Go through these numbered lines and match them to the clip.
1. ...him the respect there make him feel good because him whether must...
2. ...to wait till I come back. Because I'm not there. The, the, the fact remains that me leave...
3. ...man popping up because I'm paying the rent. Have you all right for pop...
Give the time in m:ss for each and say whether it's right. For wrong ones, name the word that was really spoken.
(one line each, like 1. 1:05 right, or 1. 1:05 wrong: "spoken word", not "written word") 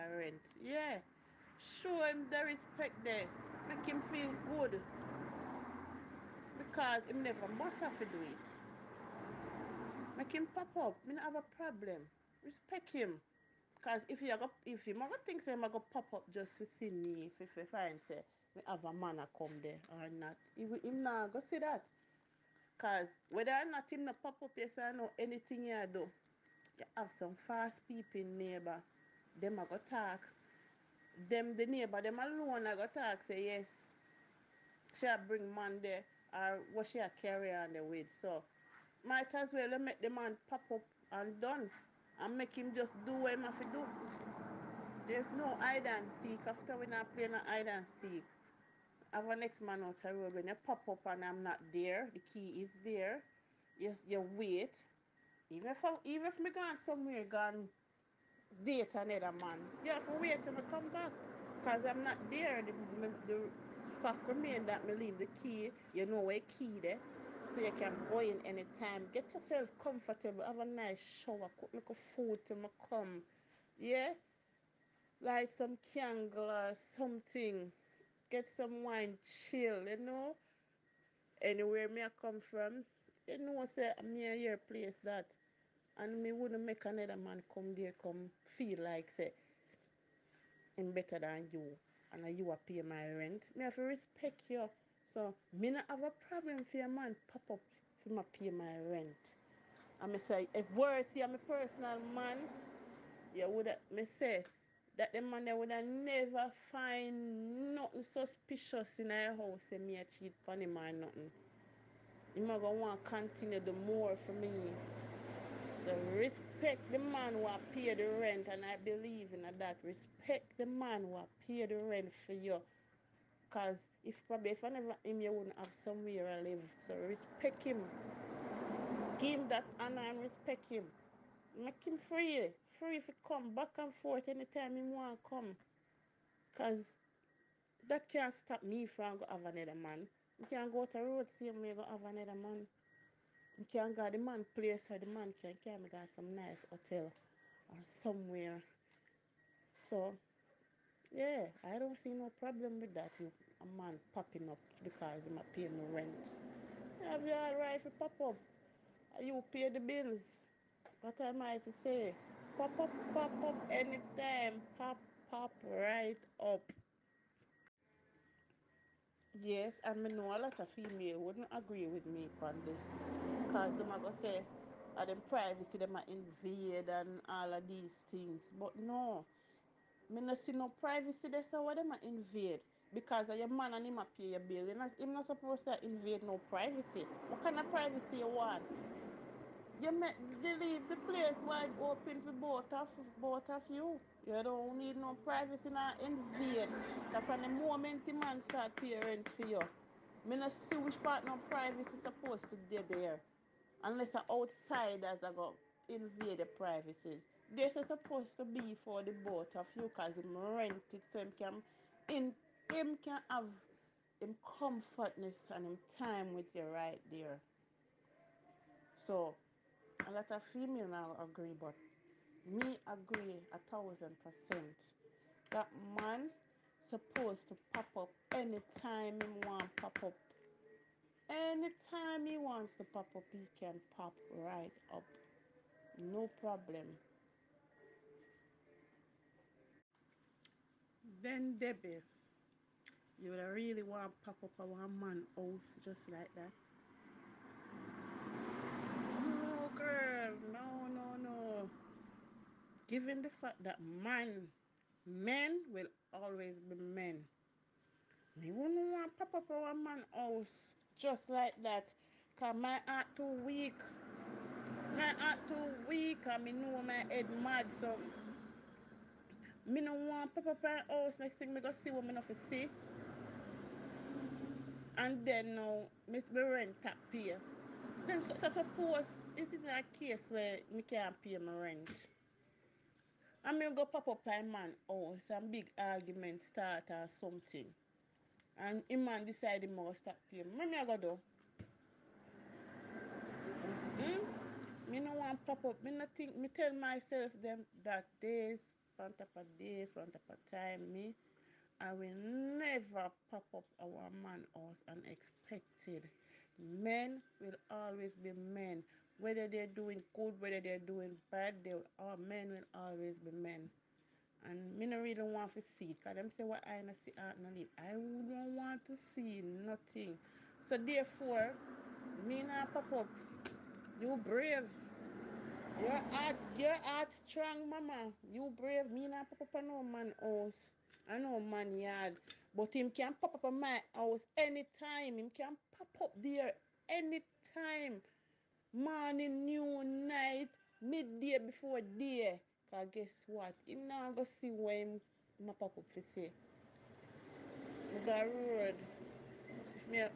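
1. 0:02 wrong: "never", not "whether"
2. 1:00 right
3. 2:33 right.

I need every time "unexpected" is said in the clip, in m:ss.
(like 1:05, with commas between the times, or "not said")
5:04.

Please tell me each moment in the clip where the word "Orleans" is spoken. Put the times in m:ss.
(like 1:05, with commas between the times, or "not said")
not said.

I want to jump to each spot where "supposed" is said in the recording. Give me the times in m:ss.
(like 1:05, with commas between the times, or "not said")
3:05, 3:21, 3:27, 3:46.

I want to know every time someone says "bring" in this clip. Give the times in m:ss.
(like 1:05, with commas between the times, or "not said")
0:35.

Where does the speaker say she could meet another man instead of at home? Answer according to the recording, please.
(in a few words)
some nice hotel.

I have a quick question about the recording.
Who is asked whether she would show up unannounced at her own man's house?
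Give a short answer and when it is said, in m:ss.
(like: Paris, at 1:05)
Debbie, at 4:01.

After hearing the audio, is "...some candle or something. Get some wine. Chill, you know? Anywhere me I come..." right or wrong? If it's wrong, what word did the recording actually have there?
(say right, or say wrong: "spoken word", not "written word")
right.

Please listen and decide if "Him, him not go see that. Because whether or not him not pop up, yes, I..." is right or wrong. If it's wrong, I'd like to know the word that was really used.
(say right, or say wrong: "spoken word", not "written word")
right.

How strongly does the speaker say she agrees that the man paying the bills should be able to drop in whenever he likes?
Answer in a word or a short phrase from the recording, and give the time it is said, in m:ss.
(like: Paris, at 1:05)
a thousand percent, at 3:43.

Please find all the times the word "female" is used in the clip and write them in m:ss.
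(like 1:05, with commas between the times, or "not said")
2:50, 3:40.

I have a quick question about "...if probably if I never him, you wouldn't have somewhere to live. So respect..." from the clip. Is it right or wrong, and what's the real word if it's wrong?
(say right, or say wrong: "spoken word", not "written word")
right.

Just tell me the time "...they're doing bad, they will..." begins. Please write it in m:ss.
5:10.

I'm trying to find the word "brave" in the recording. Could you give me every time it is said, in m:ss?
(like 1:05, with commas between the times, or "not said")
5:24, 5:28.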